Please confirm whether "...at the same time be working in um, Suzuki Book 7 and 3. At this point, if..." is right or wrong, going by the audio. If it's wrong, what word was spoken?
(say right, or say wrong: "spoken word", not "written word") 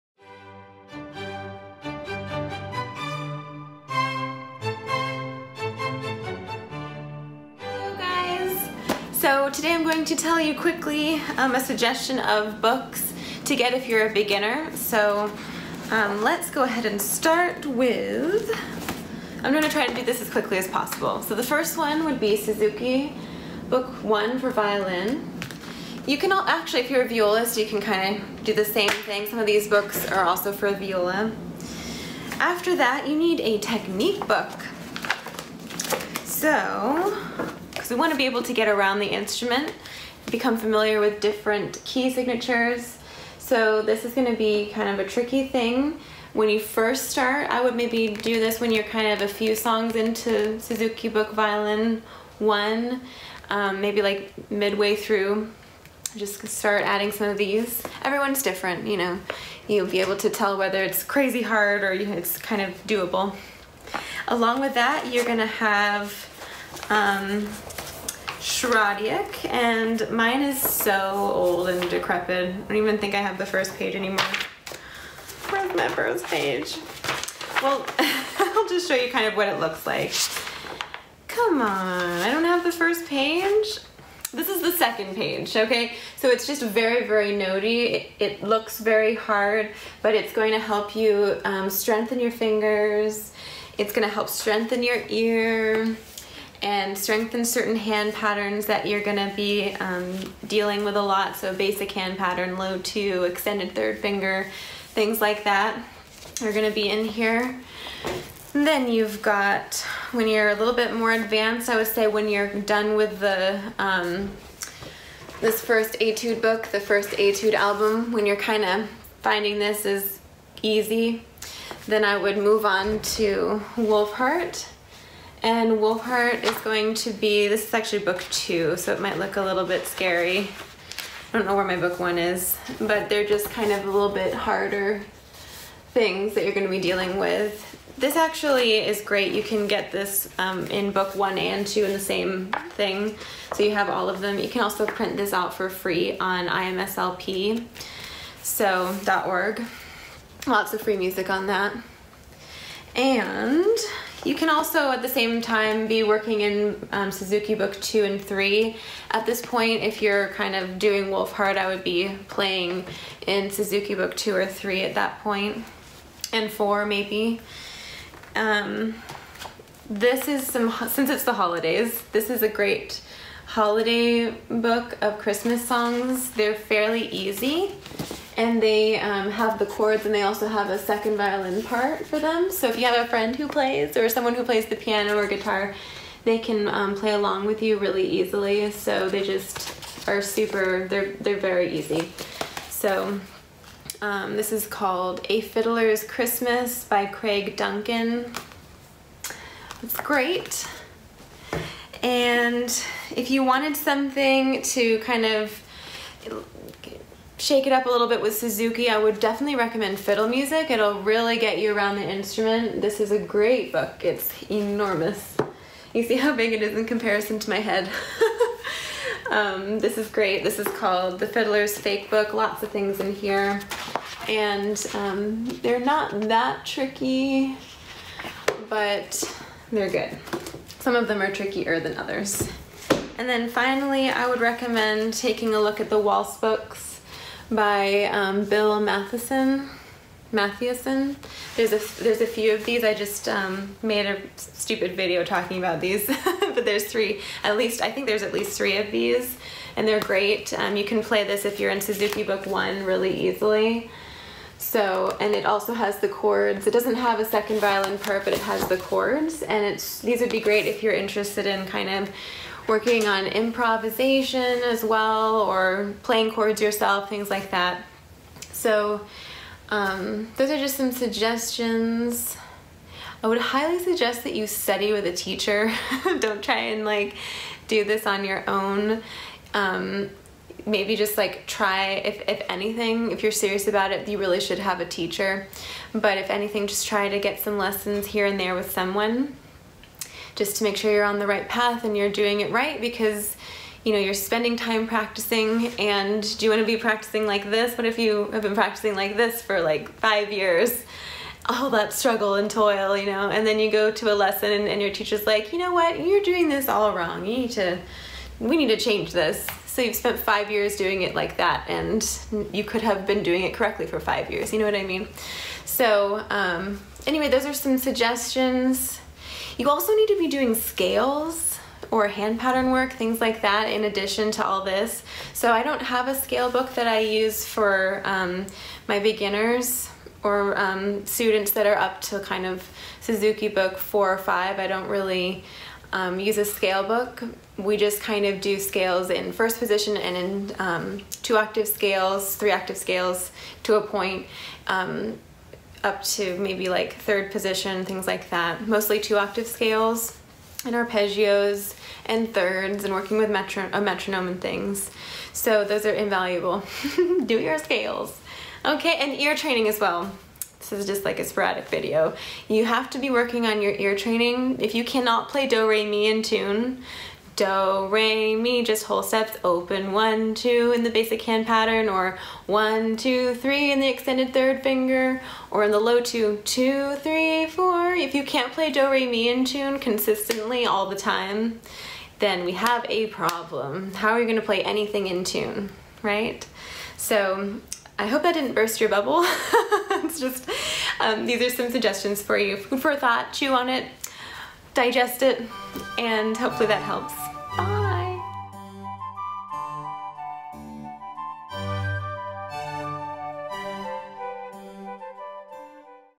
wrong: "2", not "7".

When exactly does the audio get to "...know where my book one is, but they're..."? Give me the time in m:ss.
2:11.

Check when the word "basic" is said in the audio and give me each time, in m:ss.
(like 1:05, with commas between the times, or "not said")
1:41, 6:10.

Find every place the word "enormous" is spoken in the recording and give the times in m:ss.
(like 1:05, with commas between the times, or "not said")
3:34.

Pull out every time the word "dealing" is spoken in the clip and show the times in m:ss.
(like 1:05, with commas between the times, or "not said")
1:40, 2:16.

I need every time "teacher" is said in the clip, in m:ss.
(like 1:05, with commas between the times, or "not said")
4:35, 4:44, 5:04.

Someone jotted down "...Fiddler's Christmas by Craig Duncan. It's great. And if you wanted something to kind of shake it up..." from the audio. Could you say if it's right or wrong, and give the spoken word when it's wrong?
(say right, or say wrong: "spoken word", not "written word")
right.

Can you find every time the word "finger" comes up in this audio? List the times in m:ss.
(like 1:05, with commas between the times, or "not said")
1:32, 1:43, 6:14.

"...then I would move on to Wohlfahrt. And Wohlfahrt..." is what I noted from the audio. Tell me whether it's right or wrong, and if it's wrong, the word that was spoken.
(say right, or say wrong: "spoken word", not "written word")
right.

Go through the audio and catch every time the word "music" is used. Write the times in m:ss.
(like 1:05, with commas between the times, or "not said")
2:30, 3:30.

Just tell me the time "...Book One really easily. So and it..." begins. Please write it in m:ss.
4:12.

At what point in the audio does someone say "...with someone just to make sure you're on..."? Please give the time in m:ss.
4:48.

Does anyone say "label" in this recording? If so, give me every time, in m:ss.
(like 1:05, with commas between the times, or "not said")
not said.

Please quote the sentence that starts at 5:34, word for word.
I don't really um, use a scale book.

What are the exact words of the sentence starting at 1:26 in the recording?
So it's just very, very notey.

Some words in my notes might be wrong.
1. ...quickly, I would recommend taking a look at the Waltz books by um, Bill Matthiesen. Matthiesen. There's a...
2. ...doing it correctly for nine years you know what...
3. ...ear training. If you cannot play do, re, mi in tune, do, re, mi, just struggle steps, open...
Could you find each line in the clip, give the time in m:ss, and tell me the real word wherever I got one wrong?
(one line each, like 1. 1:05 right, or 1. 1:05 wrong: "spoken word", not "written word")
1. 3:53 wrong: "finally", not "quickly"
2. 5:13 wrong: "five", not "nine"
3. 6:03 wrong: "whole", not "struggle".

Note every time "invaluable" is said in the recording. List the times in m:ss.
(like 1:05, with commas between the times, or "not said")
5:55.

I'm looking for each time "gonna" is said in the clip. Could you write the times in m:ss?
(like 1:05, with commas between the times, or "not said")
0:19, 1:05, 1:33, 1:39, 1:46, 6:24.